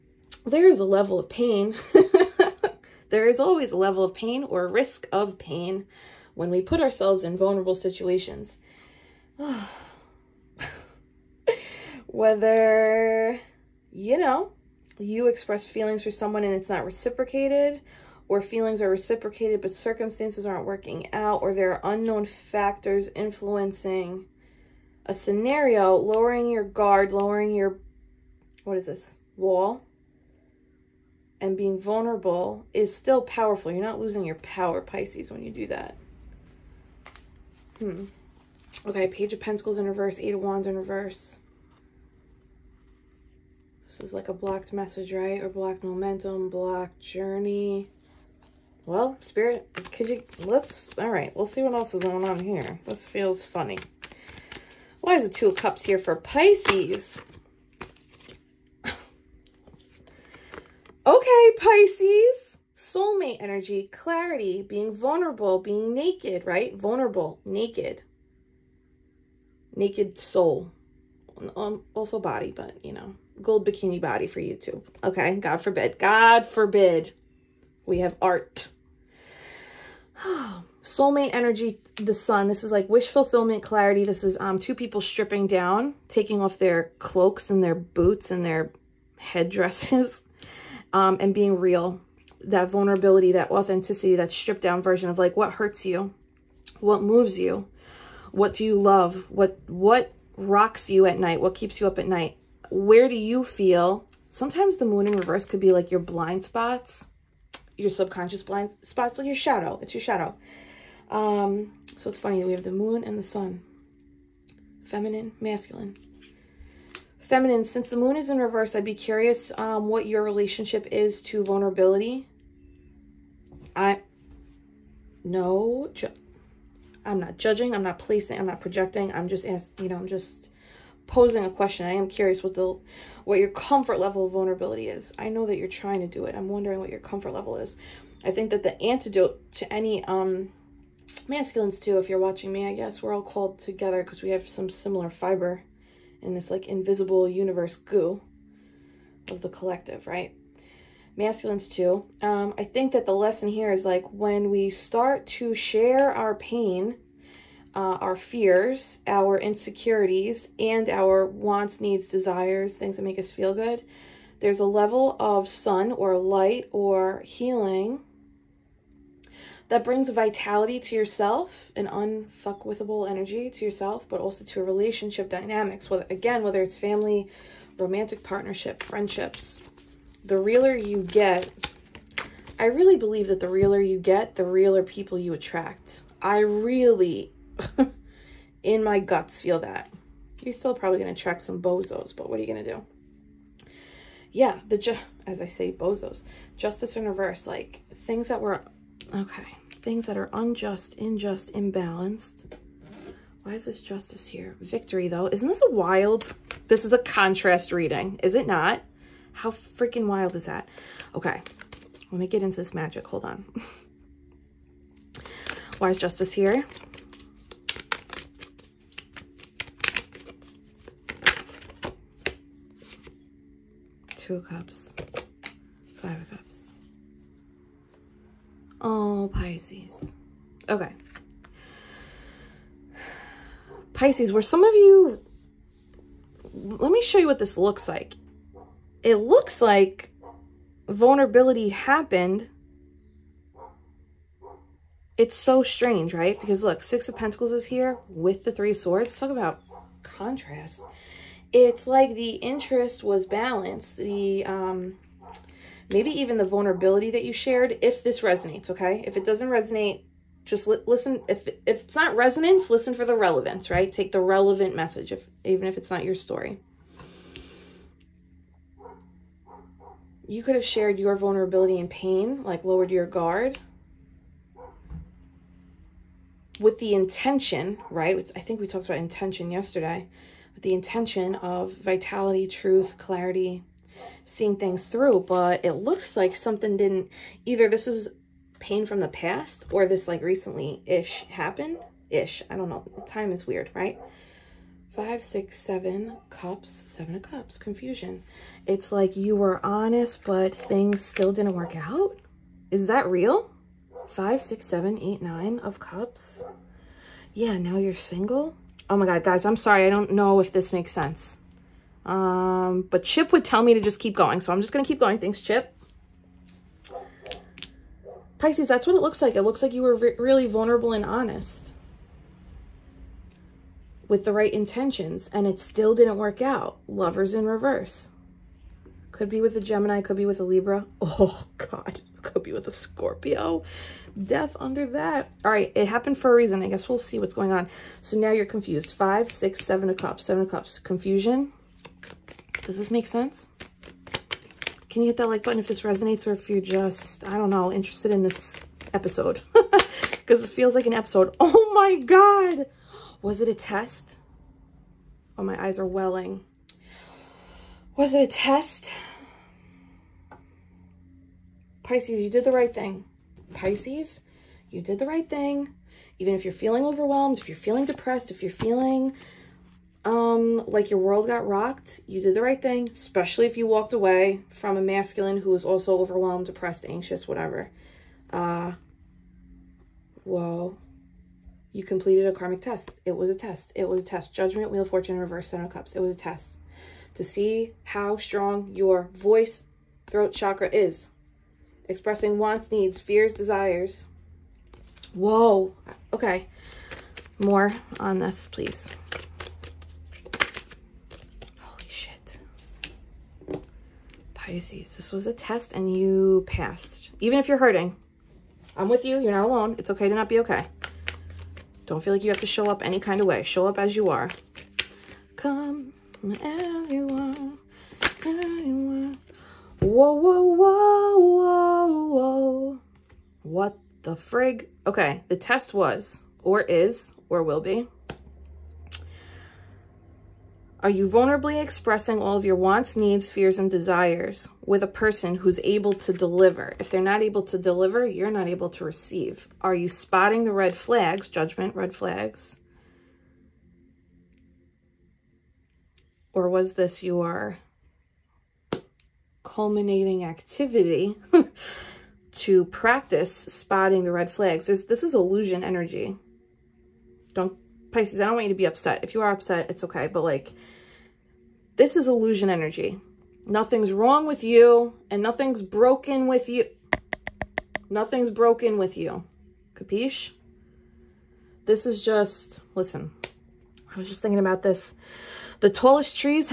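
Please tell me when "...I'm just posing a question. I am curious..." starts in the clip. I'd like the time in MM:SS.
02:09.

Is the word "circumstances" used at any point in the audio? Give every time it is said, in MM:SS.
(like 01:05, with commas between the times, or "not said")
00:19.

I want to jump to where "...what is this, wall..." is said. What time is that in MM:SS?
00:28.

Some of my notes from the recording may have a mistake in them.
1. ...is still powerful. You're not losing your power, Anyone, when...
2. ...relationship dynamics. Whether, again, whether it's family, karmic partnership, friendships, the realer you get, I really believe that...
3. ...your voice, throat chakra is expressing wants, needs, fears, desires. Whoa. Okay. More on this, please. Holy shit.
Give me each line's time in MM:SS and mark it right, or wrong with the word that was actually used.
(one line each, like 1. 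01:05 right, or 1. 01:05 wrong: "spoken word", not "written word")
1. 00:32 wrong: "Pisces", not "Anyone"
2. 02:54 wrong: "romantic", not "karmic"
3. 06:28 right.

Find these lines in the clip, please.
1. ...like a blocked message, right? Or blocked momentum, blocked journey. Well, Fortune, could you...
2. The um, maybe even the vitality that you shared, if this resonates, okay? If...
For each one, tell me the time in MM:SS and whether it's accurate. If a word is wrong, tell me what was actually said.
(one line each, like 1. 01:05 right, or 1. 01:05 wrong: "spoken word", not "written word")
1. 00:44 wrong: "Spirit", not "Fortune"
2. 04:13 wrong: "vulnerability", not "vitality".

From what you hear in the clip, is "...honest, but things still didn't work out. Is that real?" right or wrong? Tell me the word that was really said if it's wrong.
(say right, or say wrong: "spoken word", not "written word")
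right.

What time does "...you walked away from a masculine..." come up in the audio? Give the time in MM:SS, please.
06:13.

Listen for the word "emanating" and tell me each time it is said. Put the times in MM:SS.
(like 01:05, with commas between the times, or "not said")
not said.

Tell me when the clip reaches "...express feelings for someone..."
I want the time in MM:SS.
00:15.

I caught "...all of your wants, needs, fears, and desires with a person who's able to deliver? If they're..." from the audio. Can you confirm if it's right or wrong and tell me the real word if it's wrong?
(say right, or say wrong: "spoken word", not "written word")
right.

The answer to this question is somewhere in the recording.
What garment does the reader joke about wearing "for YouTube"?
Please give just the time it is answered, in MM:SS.
01:13.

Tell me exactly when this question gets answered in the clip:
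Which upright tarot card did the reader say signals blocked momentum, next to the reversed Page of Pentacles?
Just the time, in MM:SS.
00:40.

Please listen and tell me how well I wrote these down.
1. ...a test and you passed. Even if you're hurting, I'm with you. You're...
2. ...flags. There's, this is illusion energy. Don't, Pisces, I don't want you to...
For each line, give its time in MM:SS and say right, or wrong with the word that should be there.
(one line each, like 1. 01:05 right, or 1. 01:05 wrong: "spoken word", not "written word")
1. 06:45 right
2. 07:34 right.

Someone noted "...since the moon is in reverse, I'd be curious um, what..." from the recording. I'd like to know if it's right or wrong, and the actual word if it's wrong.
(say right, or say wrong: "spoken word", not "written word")
right.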